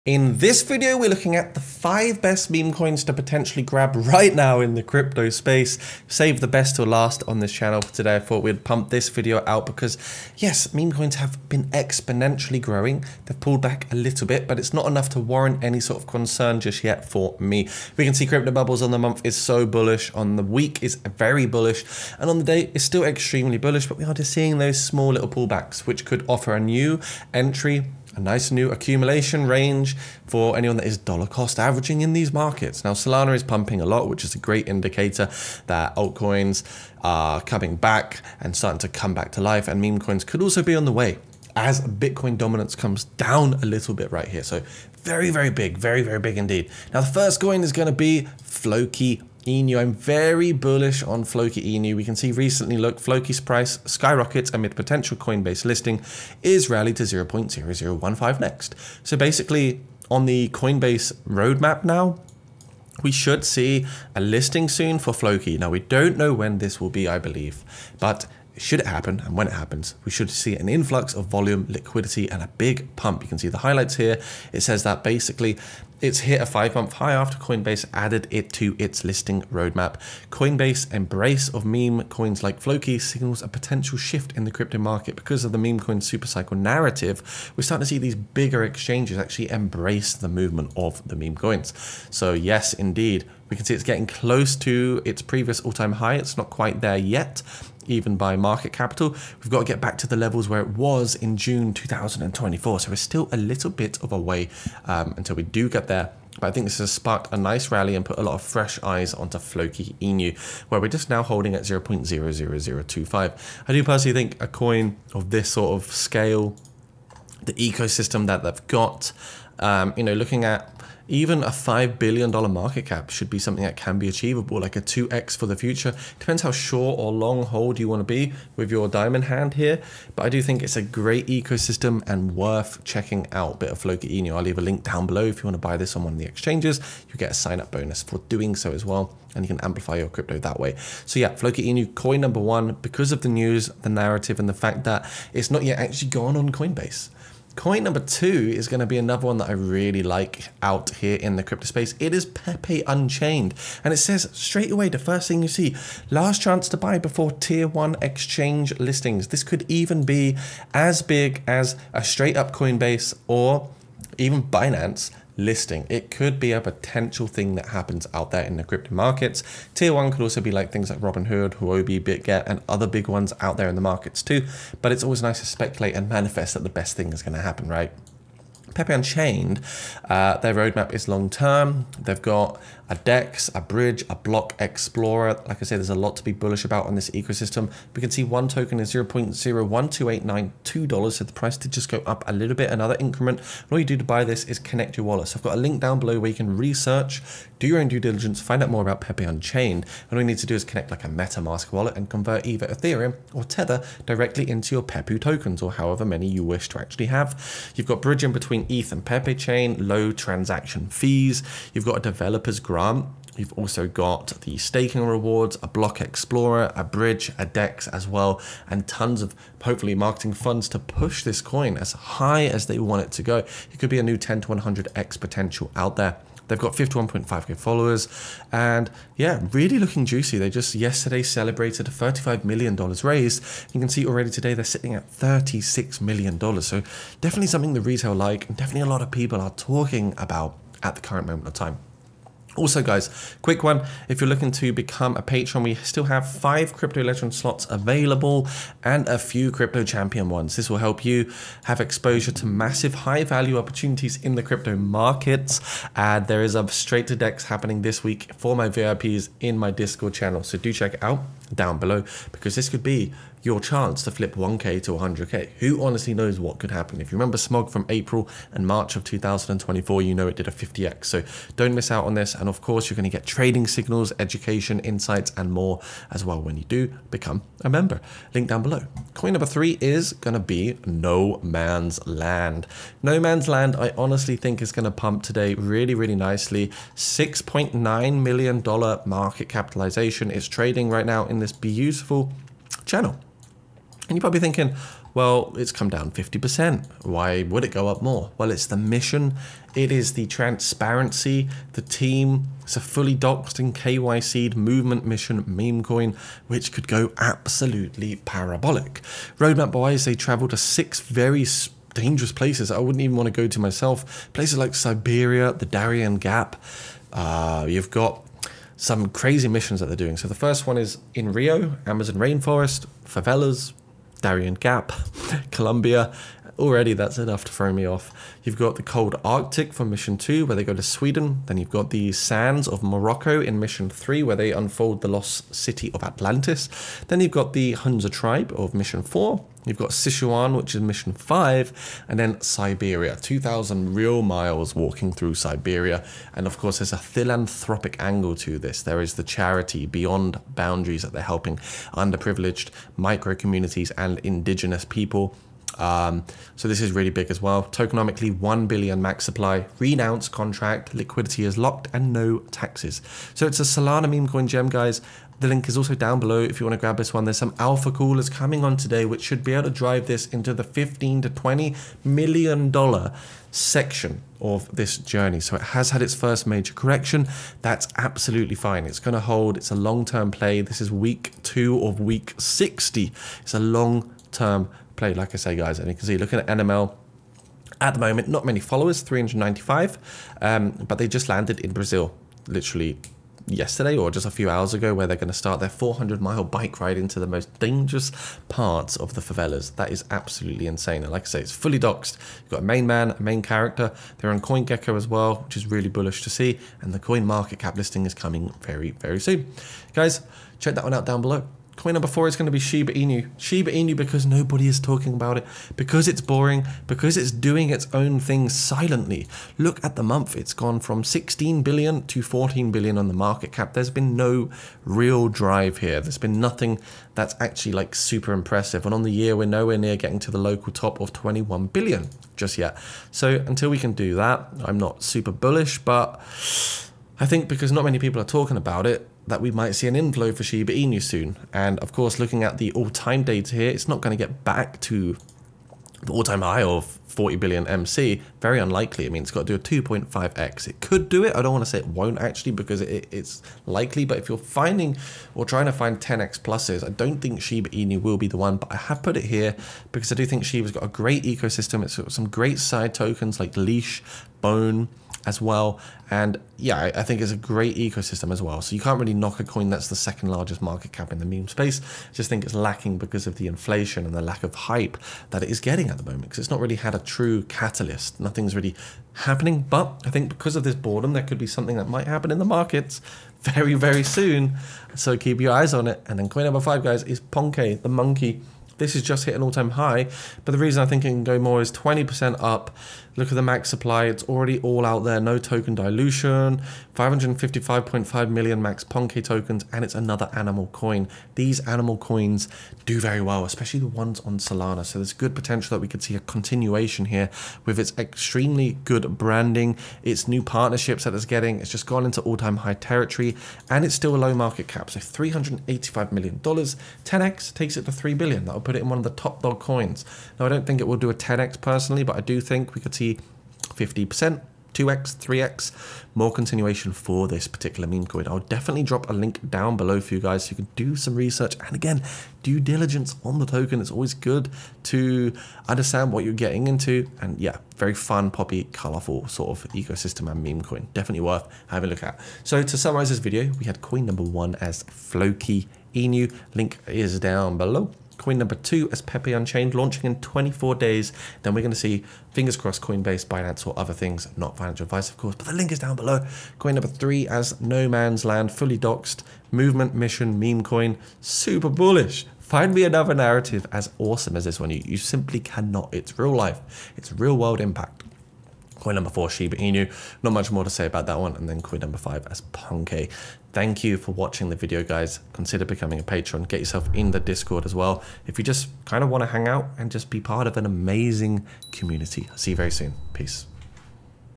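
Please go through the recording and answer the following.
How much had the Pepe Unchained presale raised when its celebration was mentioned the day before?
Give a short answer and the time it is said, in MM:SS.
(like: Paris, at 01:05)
$35 million, at 03:51.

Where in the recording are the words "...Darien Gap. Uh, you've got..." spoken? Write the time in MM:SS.
05:15.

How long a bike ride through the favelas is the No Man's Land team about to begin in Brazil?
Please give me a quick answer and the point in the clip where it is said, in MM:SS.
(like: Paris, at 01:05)
400 miles, at 06:35.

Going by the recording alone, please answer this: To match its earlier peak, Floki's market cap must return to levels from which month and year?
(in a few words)
June 2024.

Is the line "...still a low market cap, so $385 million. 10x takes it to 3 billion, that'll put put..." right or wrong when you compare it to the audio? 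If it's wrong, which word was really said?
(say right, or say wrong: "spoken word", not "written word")
right.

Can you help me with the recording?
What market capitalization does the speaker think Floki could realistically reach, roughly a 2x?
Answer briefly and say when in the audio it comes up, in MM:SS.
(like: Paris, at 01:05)
$5 billion, at 02:01.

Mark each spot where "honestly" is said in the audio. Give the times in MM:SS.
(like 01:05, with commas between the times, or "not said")
04:25, 04:43.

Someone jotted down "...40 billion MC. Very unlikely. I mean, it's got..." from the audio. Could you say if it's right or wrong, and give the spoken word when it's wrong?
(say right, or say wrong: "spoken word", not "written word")
right.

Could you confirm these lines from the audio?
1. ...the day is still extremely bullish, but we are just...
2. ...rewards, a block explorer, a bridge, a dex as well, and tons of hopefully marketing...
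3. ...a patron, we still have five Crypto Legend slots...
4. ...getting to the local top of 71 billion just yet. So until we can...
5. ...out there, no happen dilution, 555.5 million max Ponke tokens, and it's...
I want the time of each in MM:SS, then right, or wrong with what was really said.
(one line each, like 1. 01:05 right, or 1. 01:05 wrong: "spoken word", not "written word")
1. 00:22 right
2. 03:35 right
3. 04:05 right
4. 07:09 wrong: "21", not "71"
5. 08:14 wrong: "token", not "happen".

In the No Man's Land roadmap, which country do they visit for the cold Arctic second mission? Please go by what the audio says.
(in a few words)
Sweden.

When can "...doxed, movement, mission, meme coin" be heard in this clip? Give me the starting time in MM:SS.
09:18.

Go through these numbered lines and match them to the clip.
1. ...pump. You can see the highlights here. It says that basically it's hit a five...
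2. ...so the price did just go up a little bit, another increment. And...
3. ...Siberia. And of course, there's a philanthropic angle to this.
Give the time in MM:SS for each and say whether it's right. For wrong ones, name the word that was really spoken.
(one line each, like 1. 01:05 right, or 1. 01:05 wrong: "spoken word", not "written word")
1. 01:12 right
2. 03:11 right
3. 05:45 right.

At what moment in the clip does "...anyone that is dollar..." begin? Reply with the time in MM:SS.
00:30.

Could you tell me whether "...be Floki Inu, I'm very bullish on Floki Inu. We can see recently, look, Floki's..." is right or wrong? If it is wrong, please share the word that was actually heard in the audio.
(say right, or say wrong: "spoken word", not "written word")
right.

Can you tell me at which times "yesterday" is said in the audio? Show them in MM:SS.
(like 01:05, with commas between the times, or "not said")
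03:50, 06:33.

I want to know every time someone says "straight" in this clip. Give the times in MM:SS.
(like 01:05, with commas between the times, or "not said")
02:34, 02:42, 04:16.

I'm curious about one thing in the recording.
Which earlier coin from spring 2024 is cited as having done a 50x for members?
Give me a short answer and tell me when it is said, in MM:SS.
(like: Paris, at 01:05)
Smog, at 04:27.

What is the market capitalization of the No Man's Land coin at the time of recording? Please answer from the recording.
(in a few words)
$6.9 million.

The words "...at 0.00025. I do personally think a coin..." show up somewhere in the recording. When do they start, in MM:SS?
01:51.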